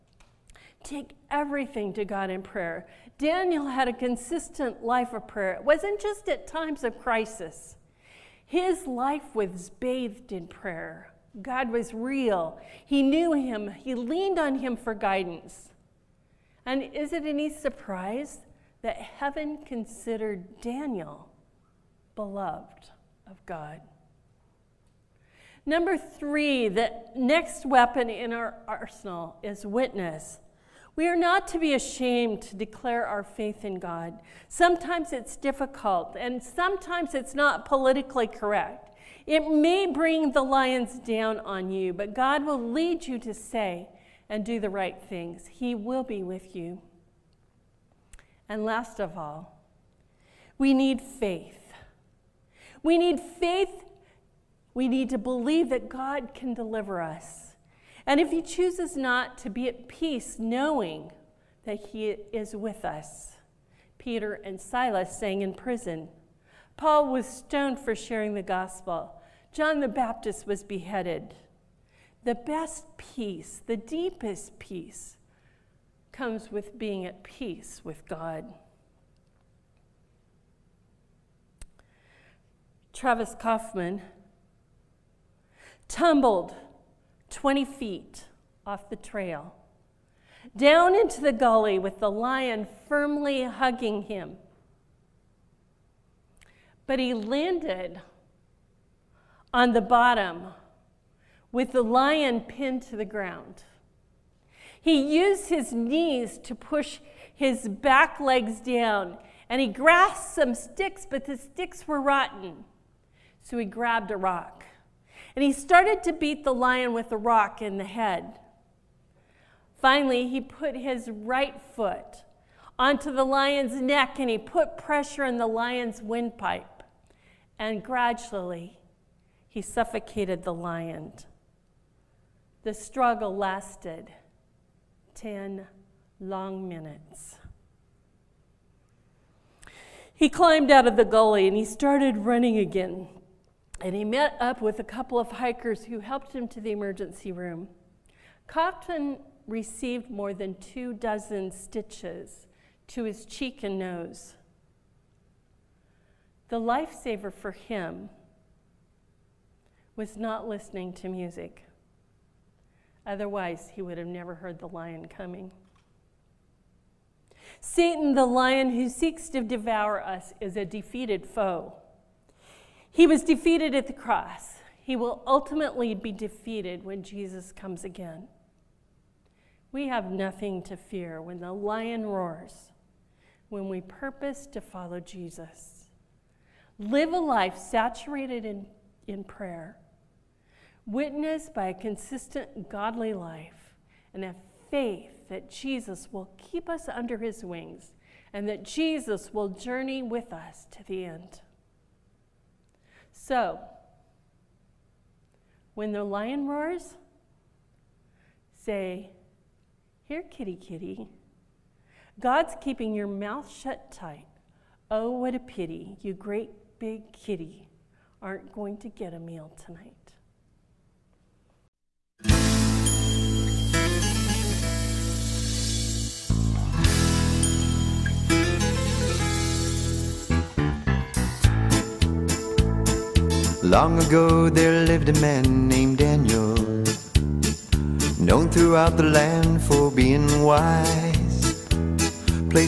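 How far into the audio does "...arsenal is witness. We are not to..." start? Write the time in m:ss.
0:28.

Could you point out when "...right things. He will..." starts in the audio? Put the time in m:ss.
0:44.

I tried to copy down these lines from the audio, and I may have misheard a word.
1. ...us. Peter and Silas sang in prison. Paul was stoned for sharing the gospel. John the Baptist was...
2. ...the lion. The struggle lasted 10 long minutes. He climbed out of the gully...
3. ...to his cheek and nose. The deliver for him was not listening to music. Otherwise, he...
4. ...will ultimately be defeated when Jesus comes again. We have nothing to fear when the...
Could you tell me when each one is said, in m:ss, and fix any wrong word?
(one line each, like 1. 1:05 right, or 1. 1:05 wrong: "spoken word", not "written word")
1. 1:02 right
2. 2:10 right
3. 2:32 wrong: "lifesaver", not "deliver"
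4. 2:54 right.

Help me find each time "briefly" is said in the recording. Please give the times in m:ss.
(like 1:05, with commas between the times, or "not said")
not said.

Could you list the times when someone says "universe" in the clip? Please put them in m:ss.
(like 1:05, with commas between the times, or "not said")
not said.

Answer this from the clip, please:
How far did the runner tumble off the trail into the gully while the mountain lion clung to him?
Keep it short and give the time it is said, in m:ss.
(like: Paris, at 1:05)
20 feet, at 1:27.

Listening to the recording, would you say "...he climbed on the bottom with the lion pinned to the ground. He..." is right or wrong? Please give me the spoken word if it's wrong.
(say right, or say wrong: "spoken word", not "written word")
wrong: "landed", not "climbed".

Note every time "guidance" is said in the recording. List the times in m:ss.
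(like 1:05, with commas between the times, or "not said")
0:14.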